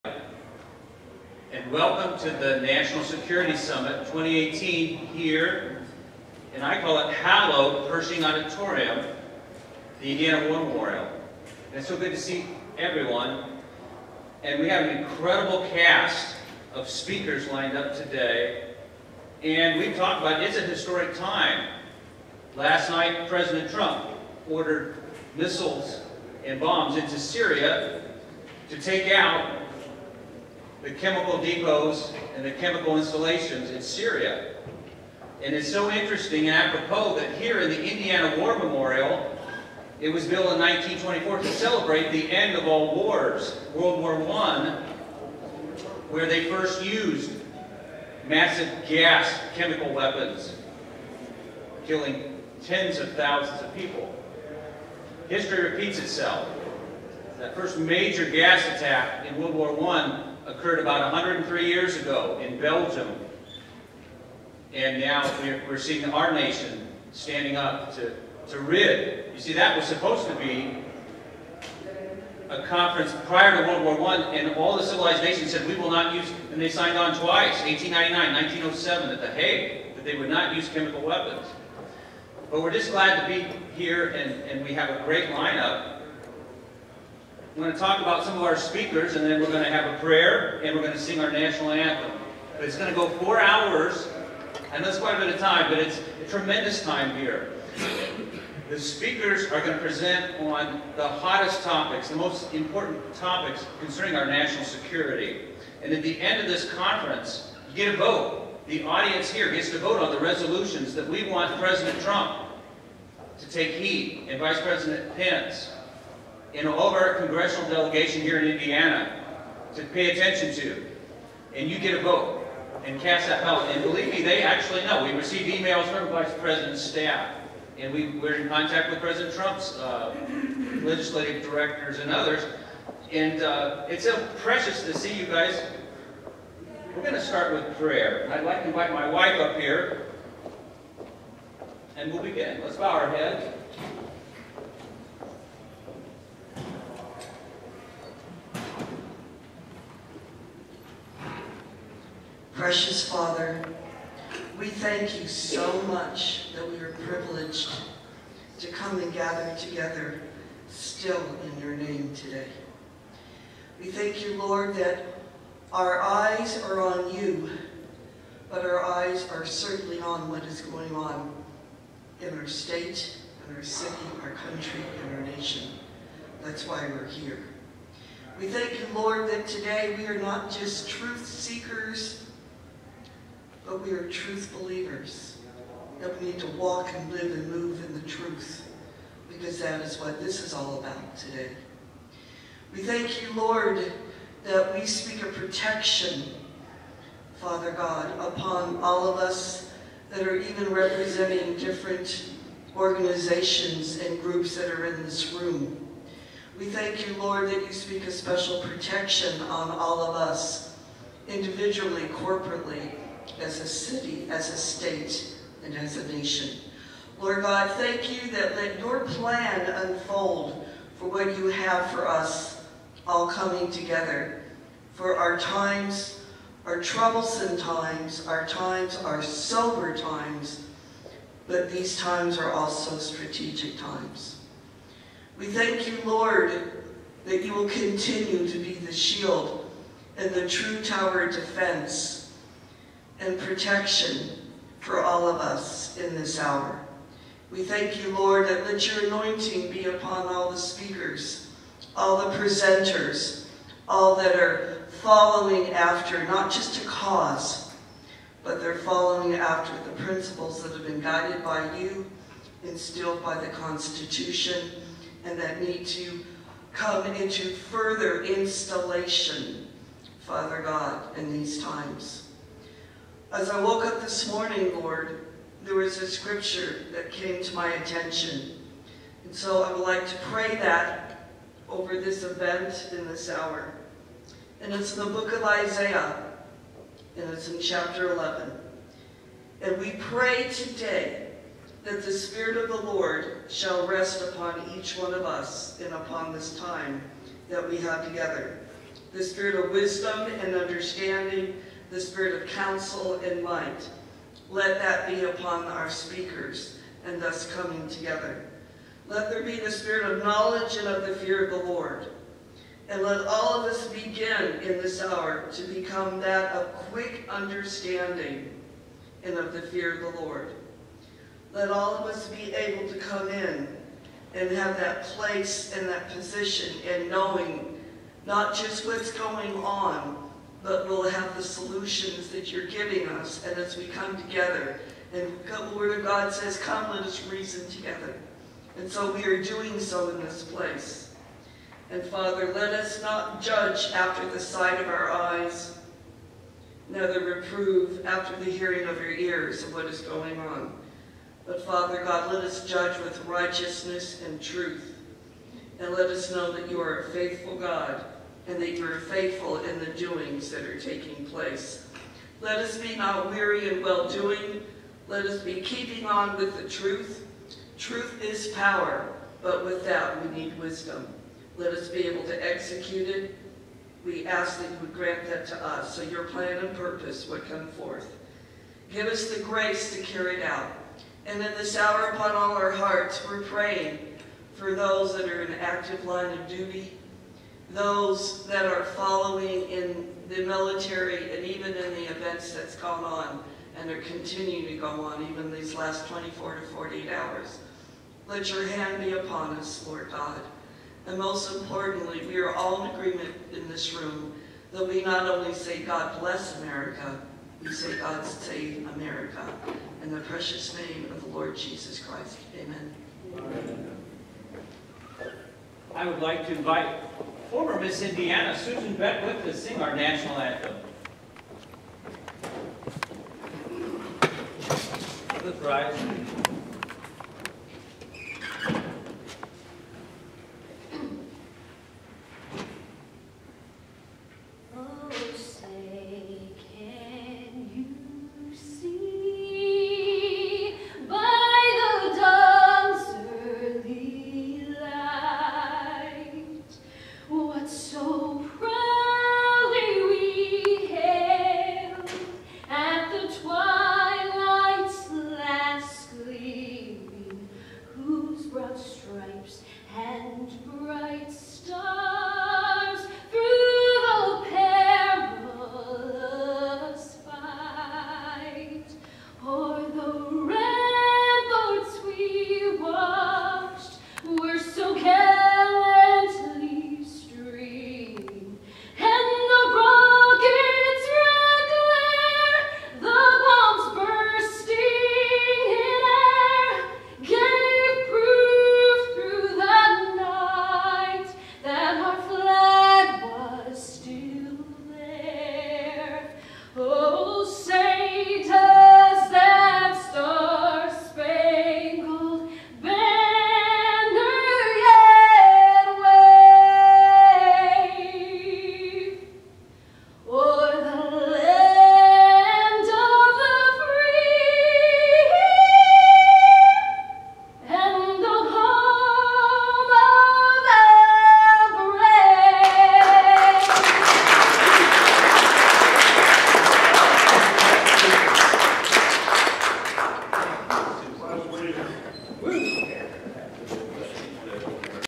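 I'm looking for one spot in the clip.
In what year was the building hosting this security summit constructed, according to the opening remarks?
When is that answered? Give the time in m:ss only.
0:40.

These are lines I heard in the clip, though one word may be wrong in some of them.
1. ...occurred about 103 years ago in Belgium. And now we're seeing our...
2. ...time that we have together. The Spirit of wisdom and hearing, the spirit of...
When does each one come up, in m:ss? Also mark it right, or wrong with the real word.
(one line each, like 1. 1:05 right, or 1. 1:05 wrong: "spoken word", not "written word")
1. 1:00 right
2. 4:56 wrong: "understanding", not "hearing".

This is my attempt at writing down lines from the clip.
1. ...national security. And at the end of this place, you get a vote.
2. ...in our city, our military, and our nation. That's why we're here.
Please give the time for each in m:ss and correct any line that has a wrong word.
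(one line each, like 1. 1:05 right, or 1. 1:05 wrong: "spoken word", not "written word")
1. 1:44 wrong: "conference", not "place"
2. 2:53 wrong: "country", not "military".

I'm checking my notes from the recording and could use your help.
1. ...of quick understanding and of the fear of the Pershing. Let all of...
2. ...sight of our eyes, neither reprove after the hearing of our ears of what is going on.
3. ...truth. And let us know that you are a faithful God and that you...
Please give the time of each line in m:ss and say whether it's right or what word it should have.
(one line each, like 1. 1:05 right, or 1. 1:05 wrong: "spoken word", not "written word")
1. 5:16 wrong: "Lord", not "Pershing"
2. 5:44 right
3. 5:54 right.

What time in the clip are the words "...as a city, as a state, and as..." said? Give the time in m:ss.
3:33.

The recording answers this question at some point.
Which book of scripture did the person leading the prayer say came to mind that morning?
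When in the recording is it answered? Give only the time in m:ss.
4:45.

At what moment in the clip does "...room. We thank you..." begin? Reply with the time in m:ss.
3:25.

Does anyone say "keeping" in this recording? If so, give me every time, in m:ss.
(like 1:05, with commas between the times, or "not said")
6:05.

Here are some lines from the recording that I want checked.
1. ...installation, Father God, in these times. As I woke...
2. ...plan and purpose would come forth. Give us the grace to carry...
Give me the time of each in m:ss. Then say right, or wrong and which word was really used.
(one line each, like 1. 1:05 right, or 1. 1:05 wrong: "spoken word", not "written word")
1. 4:28 right
2. 6:16 right.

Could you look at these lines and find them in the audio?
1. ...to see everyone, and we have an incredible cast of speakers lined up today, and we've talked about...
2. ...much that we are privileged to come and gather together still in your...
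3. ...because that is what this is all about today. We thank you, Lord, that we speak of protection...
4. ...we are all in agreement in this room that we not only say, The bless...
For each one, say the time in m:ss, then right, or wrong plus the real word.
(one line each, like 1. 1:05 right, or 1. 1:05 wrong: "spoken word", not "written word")
1. 0:12 right
2. 2:35 right
3. 3:09 right
4. 6:42 wrong: "God", not "The".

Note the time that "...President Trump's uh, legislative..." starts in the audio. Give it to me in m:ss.
2:08.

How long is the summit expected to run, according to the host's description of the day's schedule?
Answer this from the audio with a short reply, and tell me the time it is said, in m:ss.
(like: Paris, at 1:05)
Four hours, at 1:33.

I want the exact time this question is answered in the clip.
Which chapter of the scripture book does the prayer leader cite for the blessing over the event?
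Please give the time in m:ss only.
4:47.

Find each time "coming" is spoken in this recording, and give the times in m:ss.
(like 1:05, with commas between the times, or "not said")
3:43, 5:07.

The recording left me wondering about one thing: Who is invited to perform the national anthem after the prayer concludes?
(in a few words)
Susan Beckwith.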